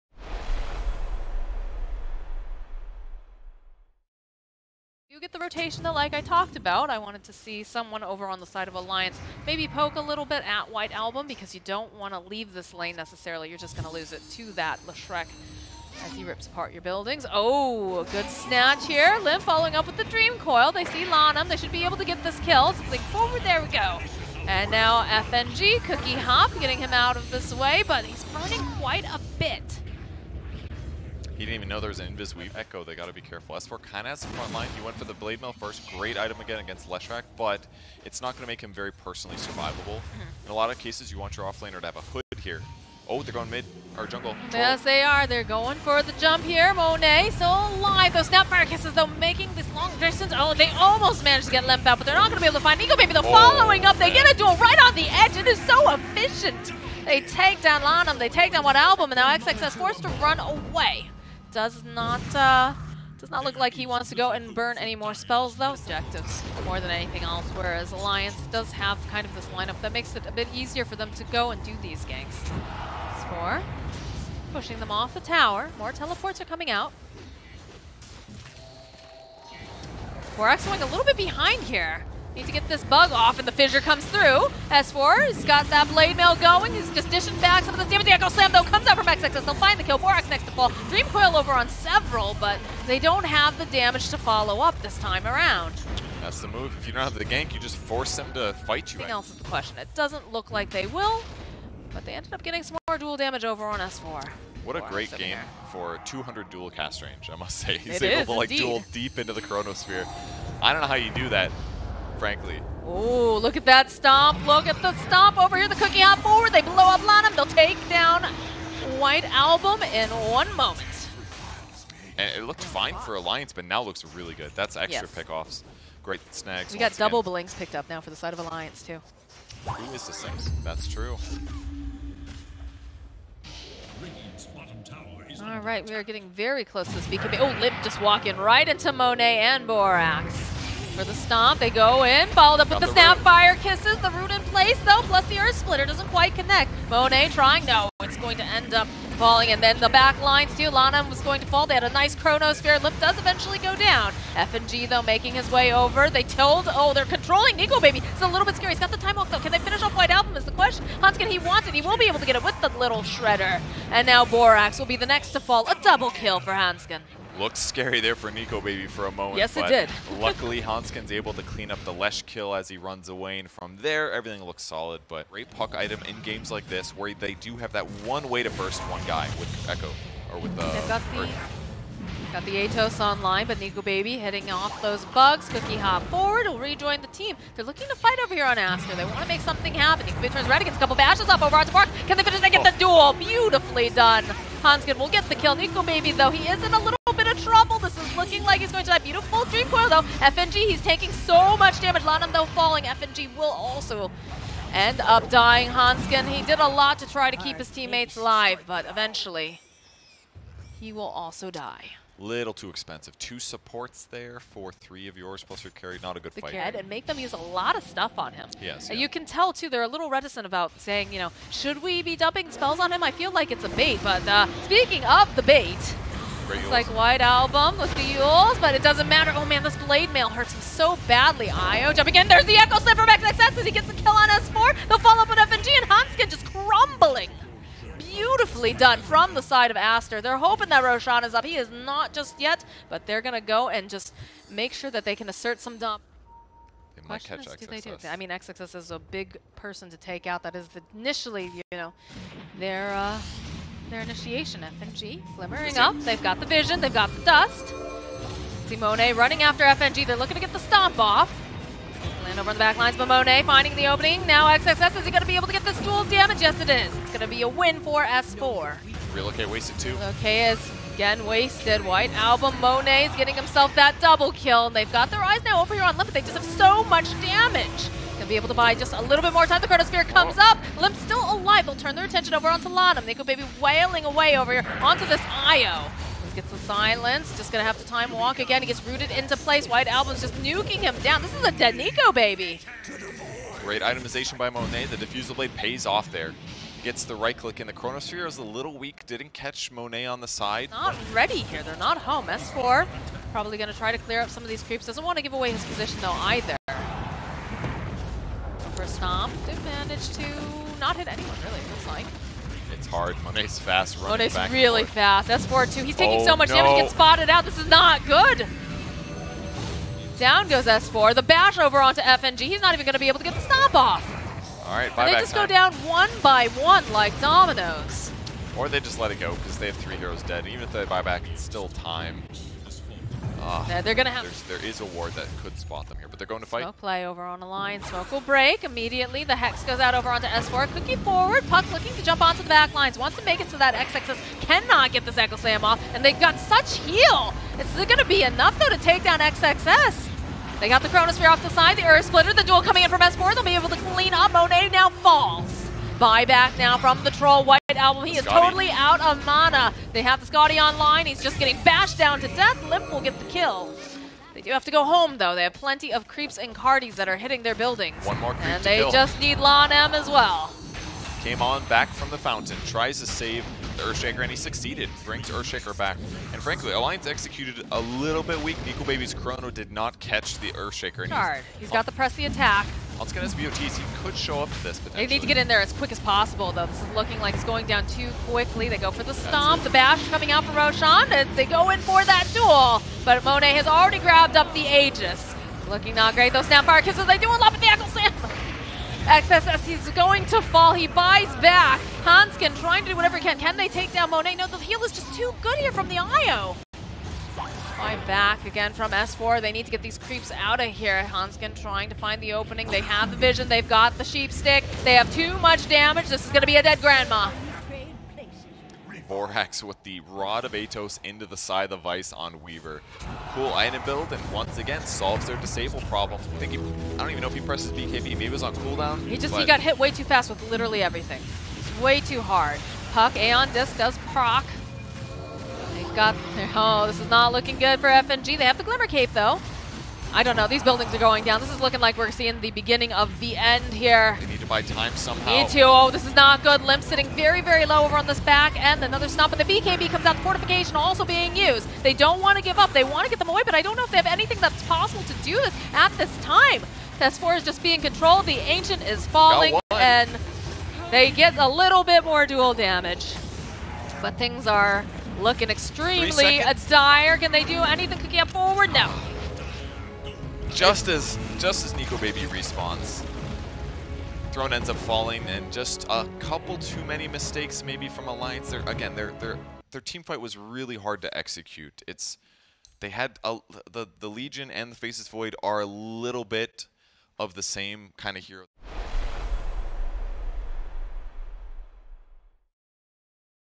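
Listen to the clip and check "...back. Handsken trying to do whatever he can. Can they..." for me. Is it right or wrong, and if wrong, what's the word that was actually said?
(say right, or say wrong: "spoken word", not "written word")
right.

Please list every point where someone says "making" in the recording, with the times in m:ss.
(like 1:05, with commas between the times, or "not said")
0:49, 2:35.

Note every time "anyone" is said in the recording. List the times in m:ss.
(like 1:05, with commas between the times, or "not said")
5:11.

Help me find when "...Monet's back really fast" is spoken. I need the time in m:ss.
5:14.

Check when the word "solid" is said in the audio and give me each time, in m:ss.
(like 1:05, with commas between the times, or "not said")
2:54.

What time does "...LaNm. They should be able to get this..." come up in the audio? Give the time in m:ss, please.
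0:21.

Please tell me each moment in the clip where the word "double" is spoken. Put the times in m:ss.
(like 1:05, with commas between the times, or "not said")
2:06, 2:45, 4:33.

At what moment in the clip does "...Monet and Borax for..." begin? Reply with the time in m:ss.
2:18.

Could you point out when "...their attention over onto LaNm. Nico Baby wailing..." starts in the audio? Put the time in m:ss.
4:41.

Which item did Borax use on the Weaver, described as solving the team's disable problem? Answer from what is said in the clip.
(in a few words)
Rod of Atos.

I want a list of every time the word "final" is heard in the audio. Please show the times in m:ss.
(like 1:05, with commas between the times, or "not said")
not said.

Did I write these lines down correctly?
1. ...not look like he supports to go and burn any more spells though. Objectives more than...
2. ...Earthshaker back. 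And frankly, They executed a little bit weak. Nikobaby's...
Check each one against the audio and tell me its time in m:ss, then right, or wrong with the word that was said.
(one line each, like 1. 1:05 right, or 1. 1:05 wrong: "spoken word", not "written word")
1. 1:03 wrong: "wants", not "supports"
2. 6:15 wrong: "Alliance", not "They".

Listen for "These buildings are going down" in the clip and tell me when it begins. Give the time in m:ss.
7:20.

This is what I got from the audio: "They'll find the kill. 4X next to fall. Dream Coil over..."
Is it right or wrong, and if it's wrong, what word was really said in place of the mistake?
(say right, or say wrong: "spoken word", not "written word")
right.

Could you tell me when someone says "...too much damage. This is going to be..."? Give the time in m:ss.
6:55.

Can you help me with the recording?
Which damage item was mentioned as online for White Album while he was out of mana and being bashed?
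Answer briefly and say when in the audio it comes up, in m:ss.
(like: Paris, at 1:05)
Skadi, at 6:00.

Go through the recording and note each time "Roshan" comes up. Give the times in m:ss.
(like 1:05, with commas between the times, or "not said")
4:00, 6:30.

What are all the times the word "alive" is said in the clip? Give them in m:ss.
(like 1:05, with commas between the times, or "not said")
0:47, 3:28, 4:41.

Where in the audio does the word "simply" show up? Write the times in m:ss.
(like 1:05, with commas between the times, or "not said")
not said.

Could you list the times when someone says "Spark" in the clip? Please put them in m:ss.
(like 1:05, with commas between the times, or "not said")
3:11.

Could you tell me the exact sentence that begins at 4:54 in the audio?
The Diffusal Blade pays off there.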